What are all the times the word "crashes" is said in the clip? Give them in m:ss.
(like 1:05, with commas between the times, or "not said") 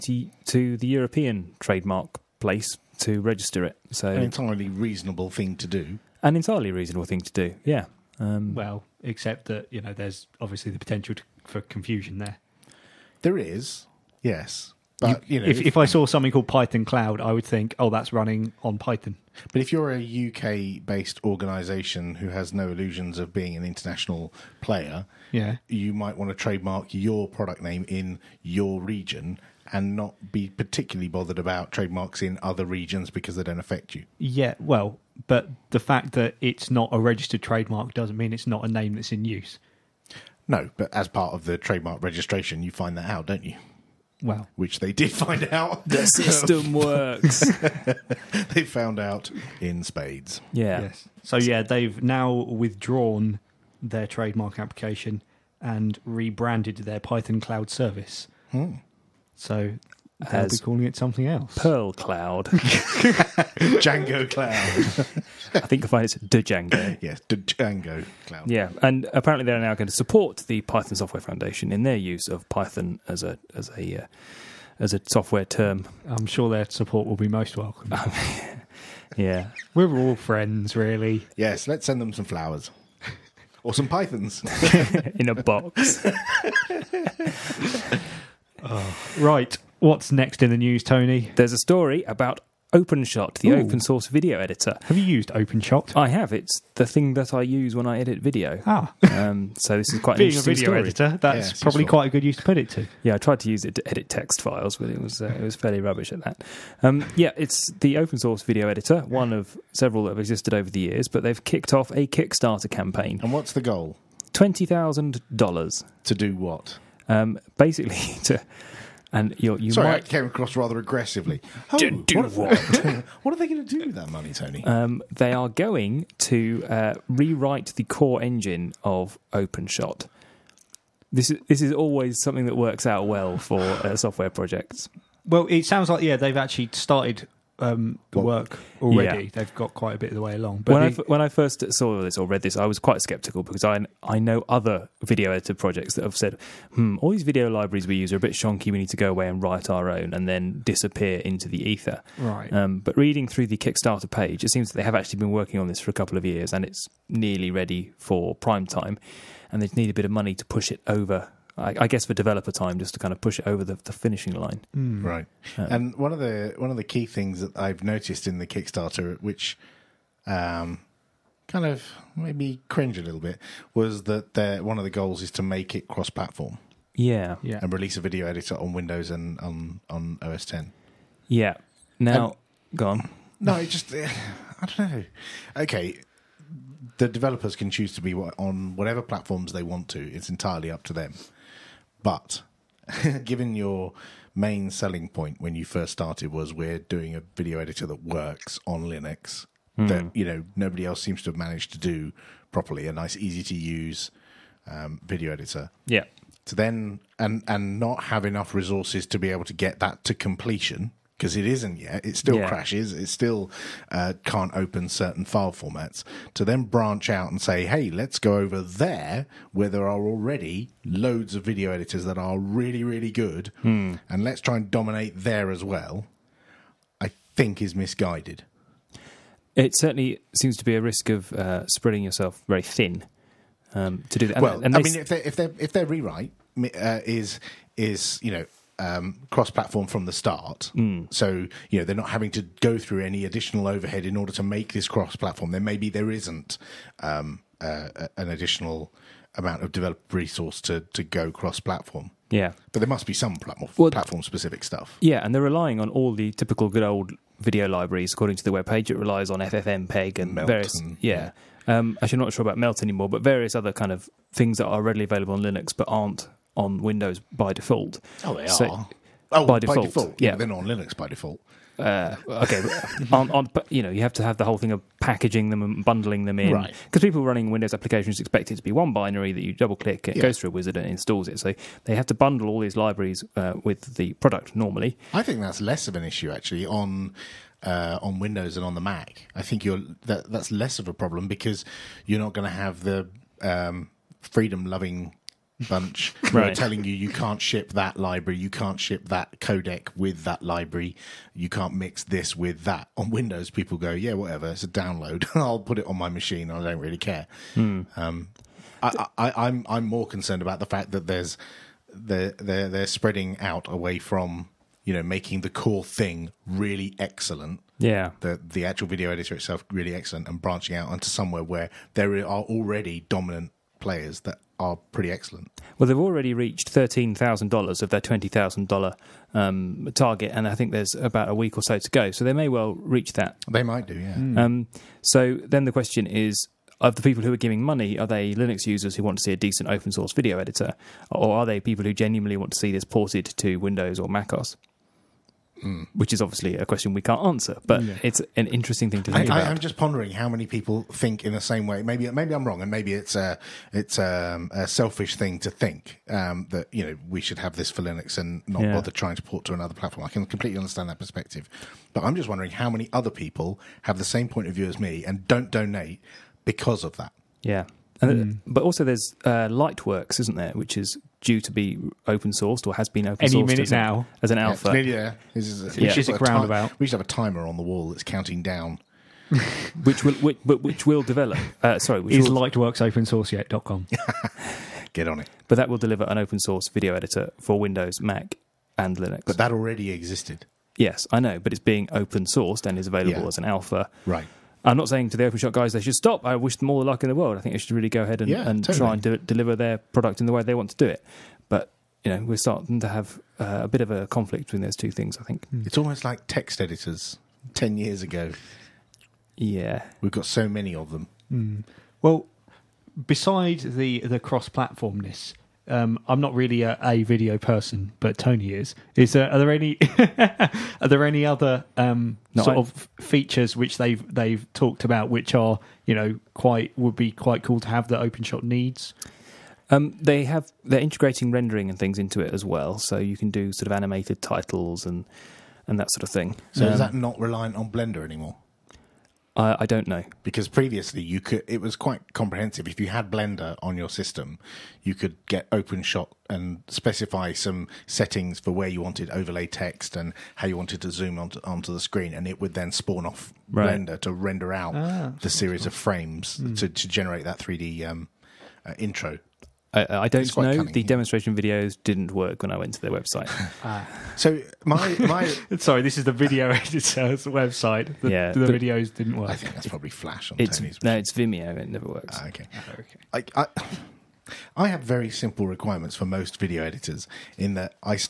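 3:32.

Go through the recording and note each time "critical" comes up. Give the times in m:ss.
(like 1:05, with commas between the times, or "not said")
not said.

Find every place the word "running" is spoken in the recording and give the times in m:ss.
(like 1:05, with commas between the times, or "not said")
0:18, 4:37.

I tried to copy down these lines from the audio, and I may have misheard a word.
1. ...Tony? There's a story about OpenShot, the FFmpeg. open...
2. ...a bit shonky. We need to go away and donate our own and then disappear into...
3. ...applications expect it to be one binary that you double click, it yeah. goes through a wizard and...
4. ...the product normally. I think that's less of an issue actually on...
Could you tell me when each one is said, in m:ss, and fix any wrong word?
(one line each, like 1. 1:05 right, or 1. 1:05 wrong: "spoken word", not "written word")
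1. 1:30 wrong: "Ooh", not "FFmpeg"
2. 2:28 wrong: "write", not "donate"
3. 4:37 right
4. 4:43 right.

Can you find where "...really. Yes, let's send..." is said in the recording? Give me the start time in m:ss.
1:20.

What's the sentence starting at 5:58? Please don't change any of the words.
bother trying to port to another platform.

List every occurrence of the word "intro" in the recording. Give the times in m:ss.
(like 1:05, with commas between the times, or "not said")
7:38.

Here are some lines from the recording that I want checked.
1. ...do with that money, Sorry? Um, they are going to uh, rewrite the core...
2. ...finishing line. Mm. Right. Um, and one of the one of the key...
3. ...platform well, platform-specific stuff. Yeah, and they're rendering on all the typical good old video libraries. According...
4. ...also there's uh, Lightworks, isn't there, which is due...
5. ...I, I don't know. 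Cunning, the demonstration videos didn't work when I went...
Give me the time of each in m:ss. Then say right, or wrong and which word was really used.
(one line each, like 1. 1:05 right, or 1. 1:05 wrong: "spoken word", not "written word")
1. 2:03 wrong: "Tony", not "Sorry"
2. 2:43 right
3. 4:13 wrong: "relying", not "rendering"
4. 6:08 right
5. 7:39 right.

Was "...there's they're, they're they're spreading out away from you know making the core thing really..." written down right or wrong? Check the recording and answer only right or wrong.
right.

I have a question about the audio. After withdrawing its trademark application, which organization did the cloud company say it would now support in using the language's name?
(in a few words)
Python Software Foundation.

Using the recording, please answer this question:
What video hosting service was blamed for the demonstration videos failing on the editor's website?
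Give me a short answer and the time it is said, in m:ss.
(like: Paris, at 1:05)
Vimeo, at 7:51.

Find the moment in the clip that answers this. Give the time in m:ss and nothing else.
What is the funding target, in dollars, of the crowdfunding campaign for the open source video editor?
1:54.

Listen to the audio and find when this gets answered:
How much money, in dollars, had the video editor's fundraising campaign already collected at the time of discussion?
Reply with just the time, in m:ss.
5:26.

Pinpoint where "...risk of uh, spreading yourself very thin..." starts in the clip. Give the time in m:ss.
3:50.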